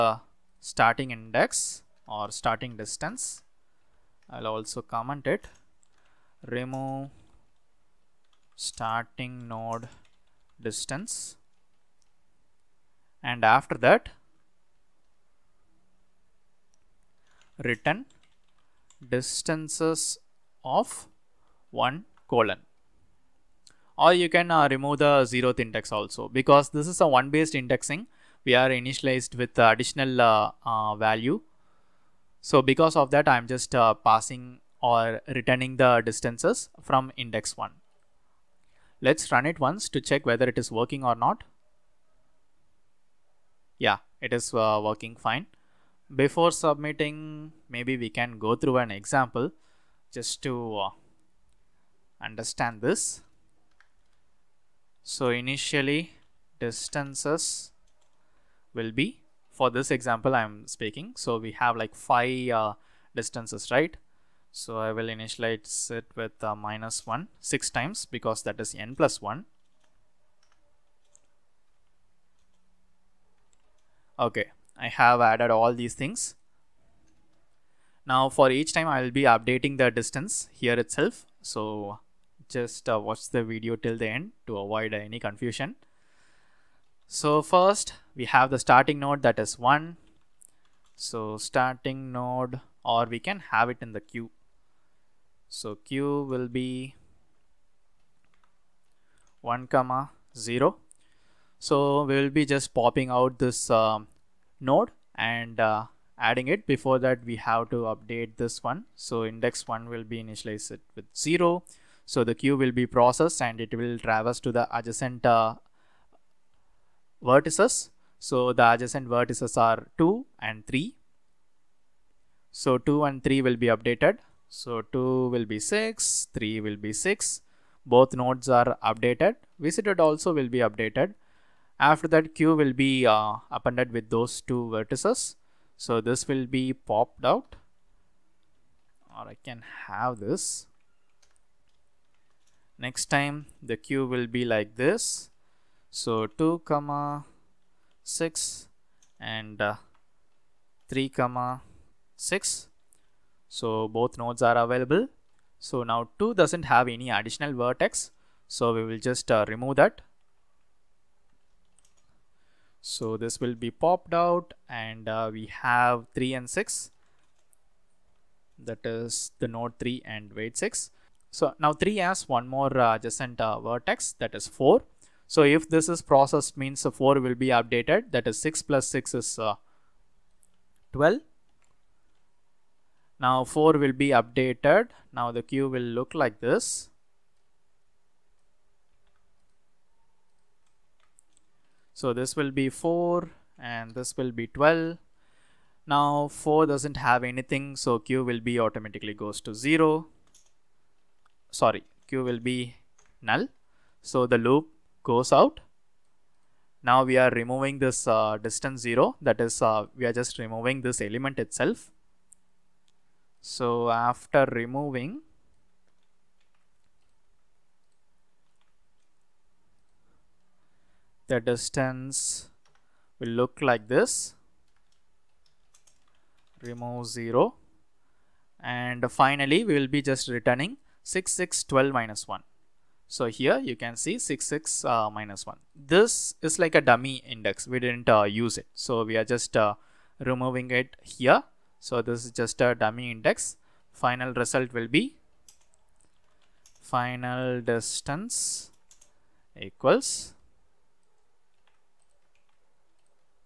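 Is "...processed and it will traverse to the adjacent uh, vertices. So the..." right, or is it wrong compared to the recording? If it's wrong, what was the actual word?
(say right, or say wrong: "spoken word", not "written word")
right.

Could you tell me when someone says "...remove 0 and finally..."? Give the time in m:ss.
3:46.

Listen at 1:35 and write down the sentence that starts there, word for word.
So queue will be 1 comma 0.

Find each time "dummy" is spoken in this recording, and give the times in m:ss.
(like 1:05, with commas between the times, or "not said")
3:56, 4:02.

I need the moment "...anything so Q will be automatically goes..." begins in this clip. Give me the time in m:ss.
3:17.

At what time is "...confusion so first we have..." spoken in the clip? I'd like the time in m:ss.
1:25.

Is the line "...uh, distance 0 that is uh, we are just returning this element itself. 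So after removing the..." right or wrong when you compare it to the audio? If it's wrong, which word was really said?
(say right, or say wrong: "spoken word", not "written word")
wrong: "removing", not "returning".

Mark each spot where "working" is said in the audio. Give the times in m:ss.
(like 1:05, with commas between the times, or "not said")
0:40, 0:44.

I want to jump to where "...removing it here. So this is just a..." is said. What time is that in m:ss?
4:00.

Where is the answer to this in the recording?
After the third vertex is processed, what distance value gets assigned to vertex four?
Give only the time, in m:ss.
2:58.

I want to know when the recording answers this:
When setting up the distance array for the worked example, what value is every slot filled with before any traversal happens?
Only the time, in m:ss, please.
1:06.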